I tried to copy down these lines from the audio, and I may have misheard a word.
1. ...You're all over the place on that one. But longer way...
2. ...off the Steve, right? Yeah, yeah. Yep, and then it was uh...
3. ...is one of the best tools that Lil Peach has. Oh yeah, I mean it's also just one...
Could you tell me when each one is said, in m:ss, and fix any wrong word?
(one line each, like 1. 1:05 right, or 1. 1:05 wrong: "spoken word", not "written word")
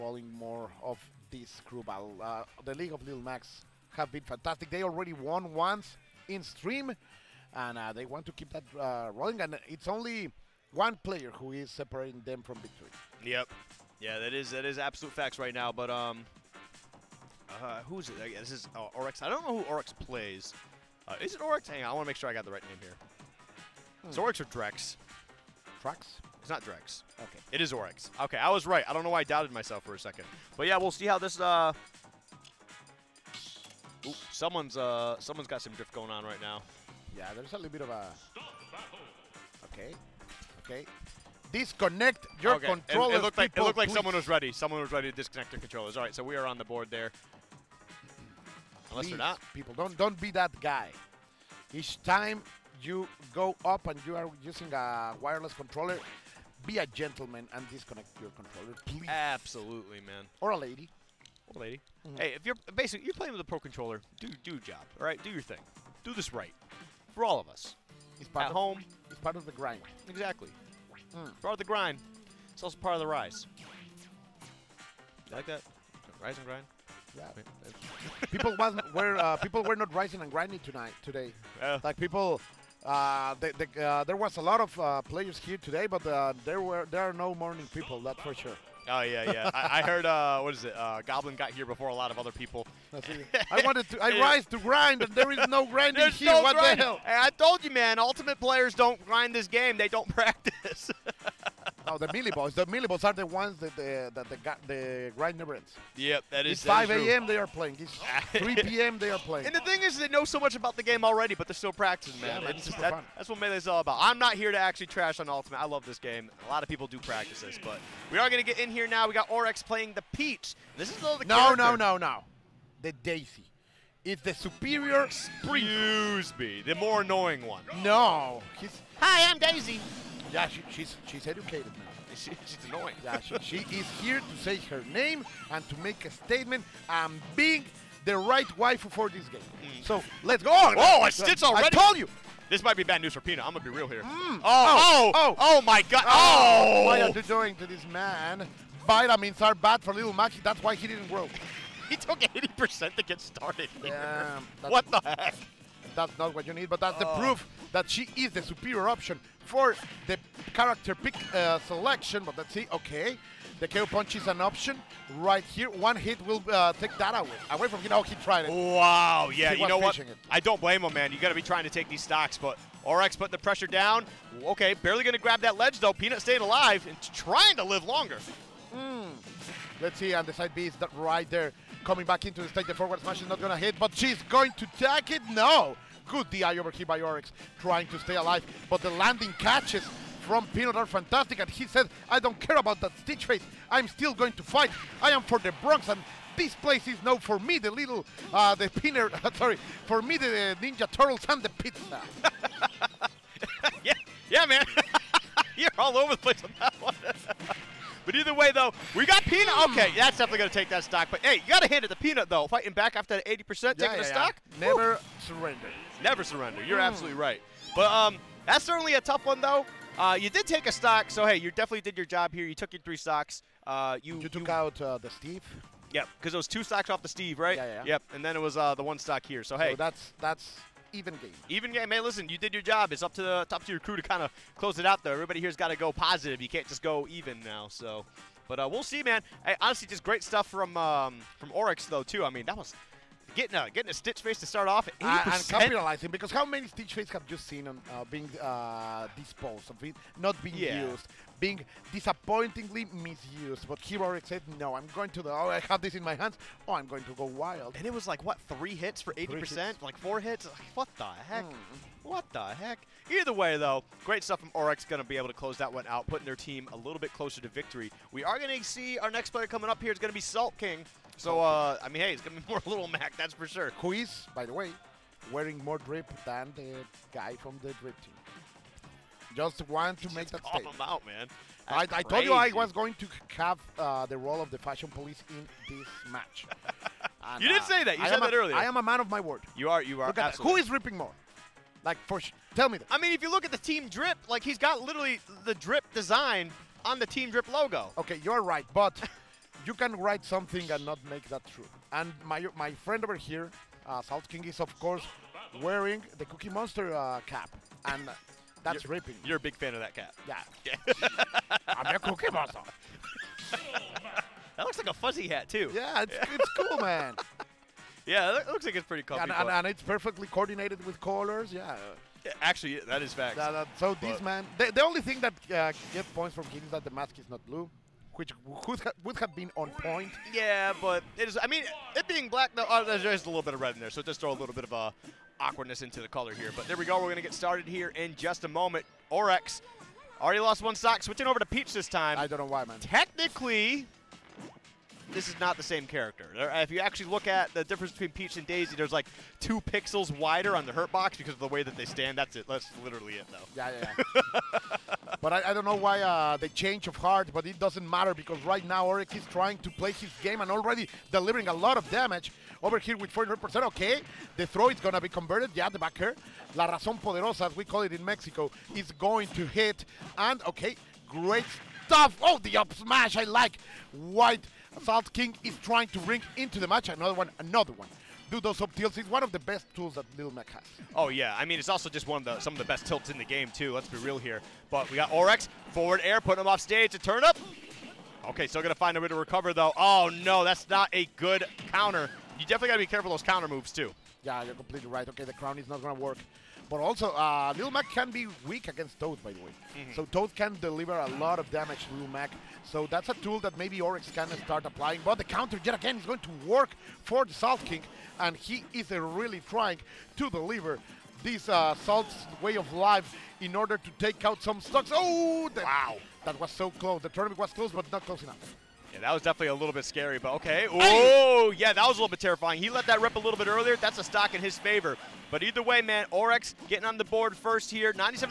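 1. 3:25 wrong: "either", not "longer"
2. 3:46 right
3. 6:18 wrong: "Mac", not "Peach".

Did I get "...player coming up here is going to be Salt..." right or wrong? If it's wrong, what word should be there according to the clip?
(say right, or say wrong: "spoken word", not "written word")
right.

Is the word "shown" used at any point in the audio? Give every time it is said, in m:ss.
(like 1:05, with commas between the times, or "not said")
not said.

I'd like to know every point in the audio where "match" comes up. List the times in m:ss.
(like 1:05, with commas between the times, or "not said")
4:46, 6:16.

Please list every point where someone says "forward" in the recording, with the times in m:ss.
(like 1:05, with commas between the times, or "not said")
3:02, 6:25.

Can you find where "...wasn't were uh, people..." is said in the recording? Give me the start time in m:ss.
1:18.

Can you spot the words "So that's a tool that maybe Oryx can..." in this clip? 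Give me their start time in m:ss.
6:42.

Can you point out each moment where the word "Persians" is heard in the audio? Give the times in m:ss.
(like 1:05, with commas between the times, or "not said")
not said.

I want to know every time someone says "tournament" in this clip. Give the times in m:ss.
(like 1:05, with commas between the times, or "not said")
6:57.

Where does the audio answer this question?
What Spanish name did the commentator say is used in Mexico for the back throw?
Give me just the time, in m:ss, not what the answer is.
6:06.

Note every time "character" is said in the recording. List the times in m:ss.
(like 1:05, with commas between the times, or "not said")
2:01, 2:40, 5:45.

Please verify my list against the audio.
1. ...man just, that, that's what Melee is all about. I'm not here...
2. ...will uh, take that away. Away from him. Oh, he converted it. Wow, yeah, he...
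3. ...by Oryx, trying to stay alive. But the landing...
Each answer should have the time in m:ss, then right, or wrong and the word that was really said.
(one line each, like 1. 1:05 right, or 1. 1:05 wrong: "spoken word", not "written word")
1. 1:52 right
2. 2:46 wrong: "tried", not "converted"
3. 3:06 right.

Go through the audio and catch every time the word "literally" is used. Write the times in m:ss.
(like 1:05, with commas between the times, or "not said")
4:54, 5:52.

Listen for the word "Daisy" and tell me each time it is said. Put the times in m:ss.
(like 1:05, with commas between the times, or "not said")
2:02, 2:09, 5:48.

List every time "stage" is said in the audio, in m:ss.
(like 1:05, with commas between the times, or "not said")
3:02, 6:26.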